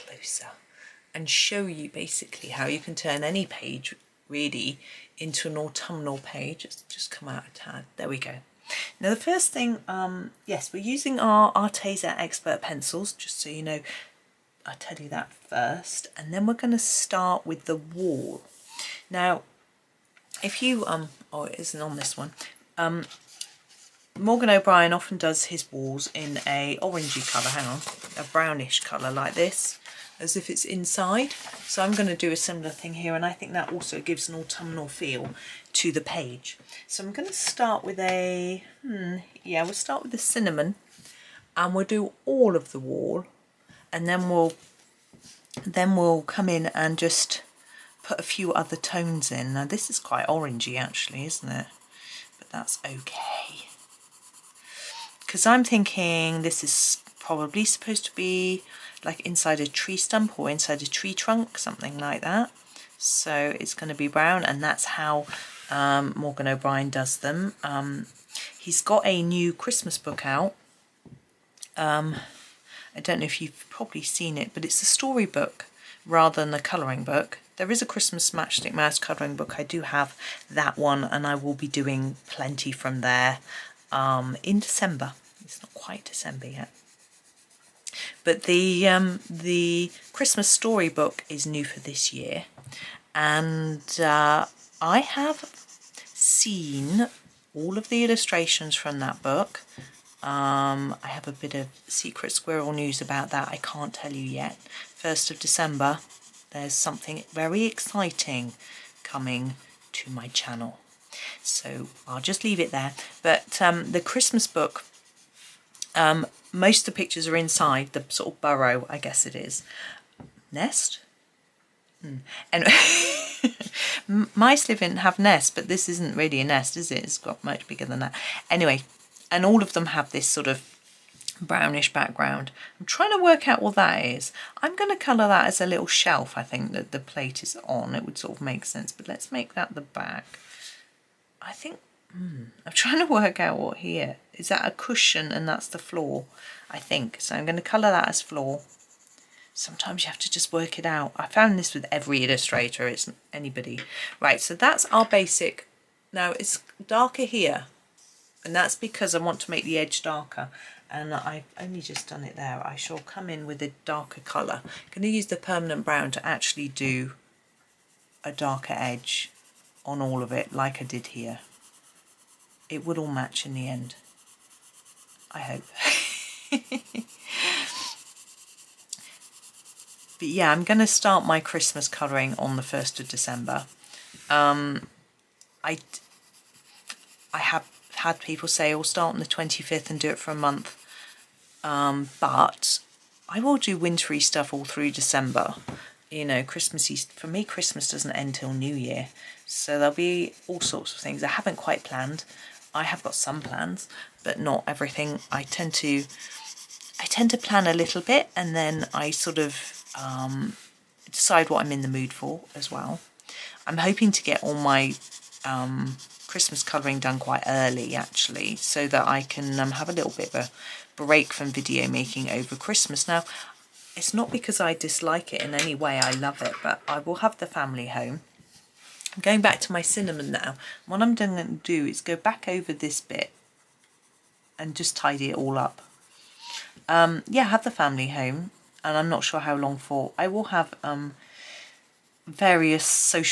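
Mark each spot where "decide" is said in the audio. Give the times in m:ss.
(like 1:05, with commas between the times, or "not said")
3:31.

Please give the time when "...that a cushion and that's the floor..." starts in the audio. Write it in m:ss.
2:24.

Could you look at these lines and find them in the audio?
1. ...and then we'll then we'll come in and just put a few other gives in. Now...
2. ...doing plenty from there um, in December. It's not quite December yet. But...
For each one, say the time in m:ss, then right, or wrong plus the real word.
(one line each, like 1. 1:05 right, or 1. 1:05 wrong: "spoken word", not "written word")
1. 0:43 wrong: "tones", not "gives"
2. 1:21 right.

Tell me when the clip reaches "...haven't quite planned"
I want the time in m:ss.
3:21.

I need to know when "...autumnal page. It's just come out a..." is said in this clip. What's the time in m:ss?
0:05.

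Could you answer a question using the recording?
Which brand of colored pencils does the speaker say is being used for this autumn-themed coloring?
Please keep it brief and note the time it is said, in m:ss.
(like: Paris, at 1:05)
Arteza Expert, at 0:11.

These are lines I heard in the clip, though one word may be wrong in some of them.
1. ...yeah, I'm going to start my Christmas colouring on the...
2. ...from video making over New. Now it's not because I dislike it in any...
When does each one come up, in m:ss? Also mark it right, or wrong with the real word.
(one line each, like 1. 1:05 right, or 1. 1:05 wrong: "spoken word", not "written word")
1. 3:00 right
2. 3:41 wrong: "Christmas", not "New".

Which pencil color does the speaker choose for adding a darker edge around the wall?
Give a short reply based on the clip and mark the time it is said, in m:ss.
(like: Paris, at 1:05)
permanent brown, at 2:45.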